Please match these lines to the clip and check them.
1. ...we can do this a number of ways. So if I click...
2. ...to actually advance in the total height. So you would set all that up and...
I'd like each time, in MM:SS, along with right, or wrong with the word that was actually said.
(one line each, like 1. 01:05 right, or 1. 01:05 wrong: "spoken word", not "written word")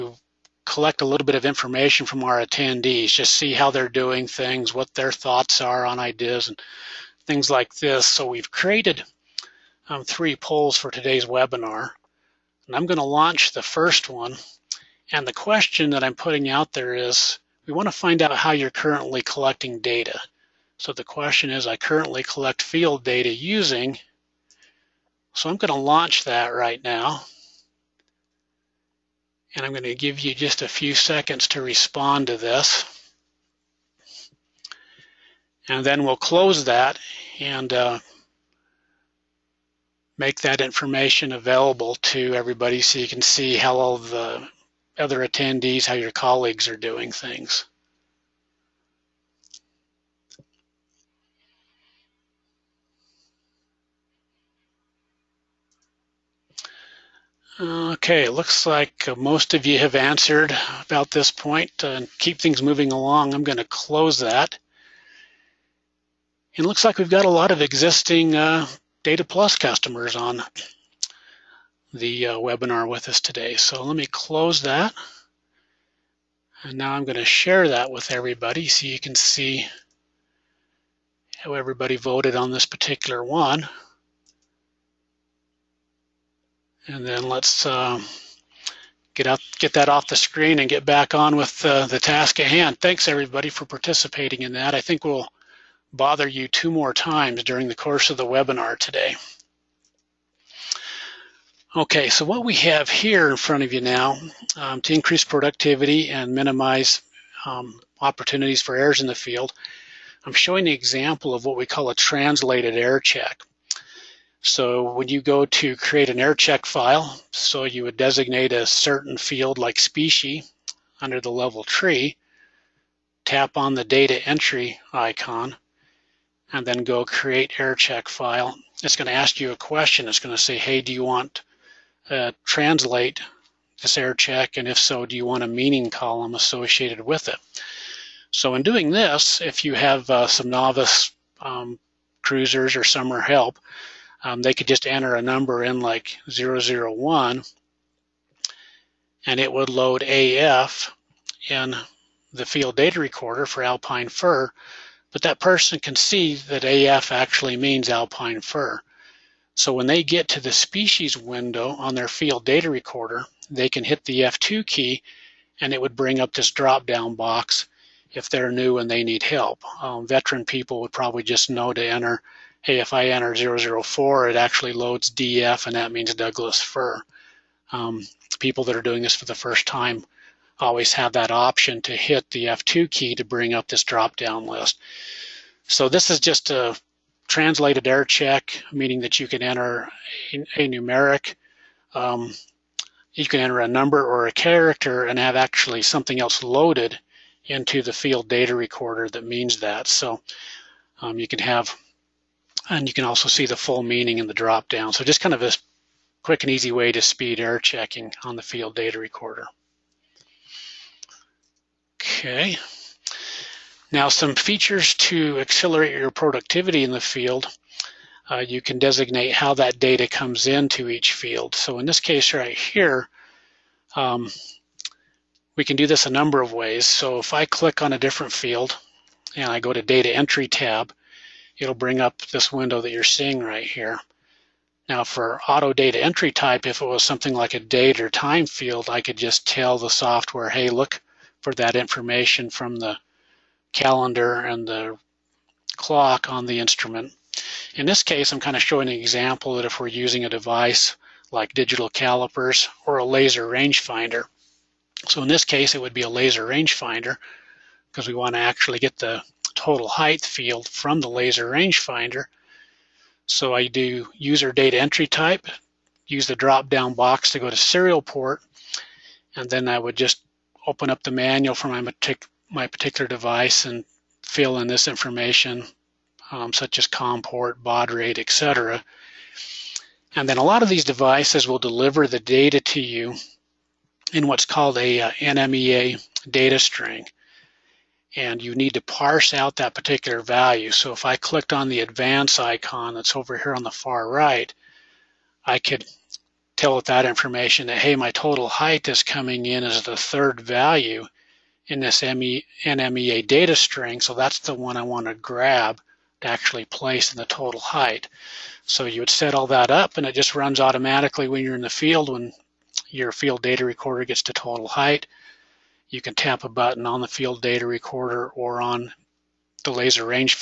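1. 03:45 right
2. 05:06 wrong: "place", not "advance".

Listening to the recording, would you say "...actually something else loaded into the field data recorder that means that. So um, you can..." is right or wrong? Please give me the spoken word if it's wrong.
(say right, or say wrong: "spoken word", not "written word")
right.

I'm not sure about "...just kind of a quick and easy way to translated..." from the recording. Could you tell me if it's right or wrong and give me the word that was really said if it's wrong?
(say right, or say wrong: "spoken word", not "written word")
wrong: "speed", not "translated".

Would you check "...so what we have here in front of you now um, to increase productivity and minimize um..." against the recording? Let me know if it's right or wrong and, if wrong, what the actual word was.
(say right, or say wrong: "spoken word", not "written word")
right.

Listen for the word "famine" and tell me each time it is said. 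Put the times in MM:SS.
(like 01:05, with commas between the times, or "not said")
not said.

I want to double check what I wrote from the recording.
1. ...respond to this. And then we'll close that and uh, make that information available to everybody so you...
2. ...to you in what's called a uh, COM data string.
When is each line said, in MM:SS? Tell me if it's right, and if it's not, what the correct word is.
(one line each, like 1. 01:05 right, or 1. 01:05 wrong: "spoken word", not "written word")
1. 00:31 right
2. 04:42 wrong: "NMEA", not "COM".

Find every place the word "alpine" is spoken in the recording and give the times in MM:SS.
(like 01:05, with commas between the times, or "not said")
02:33, 02:37.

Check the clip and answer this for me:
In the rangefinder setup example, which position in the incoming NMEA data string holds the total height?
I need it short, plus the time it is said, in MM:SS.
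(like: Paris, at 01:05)
third value, at 04:59.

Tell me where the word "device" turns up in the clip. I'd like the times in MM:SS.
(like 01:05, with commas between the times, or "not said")
04:10, 04:33, 04:40.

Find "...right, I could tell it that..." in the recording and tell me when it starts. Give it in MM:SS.
04:54.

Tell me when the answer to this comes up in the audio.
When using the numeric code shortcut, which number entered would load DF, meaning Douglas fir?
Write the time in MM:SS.
02:53.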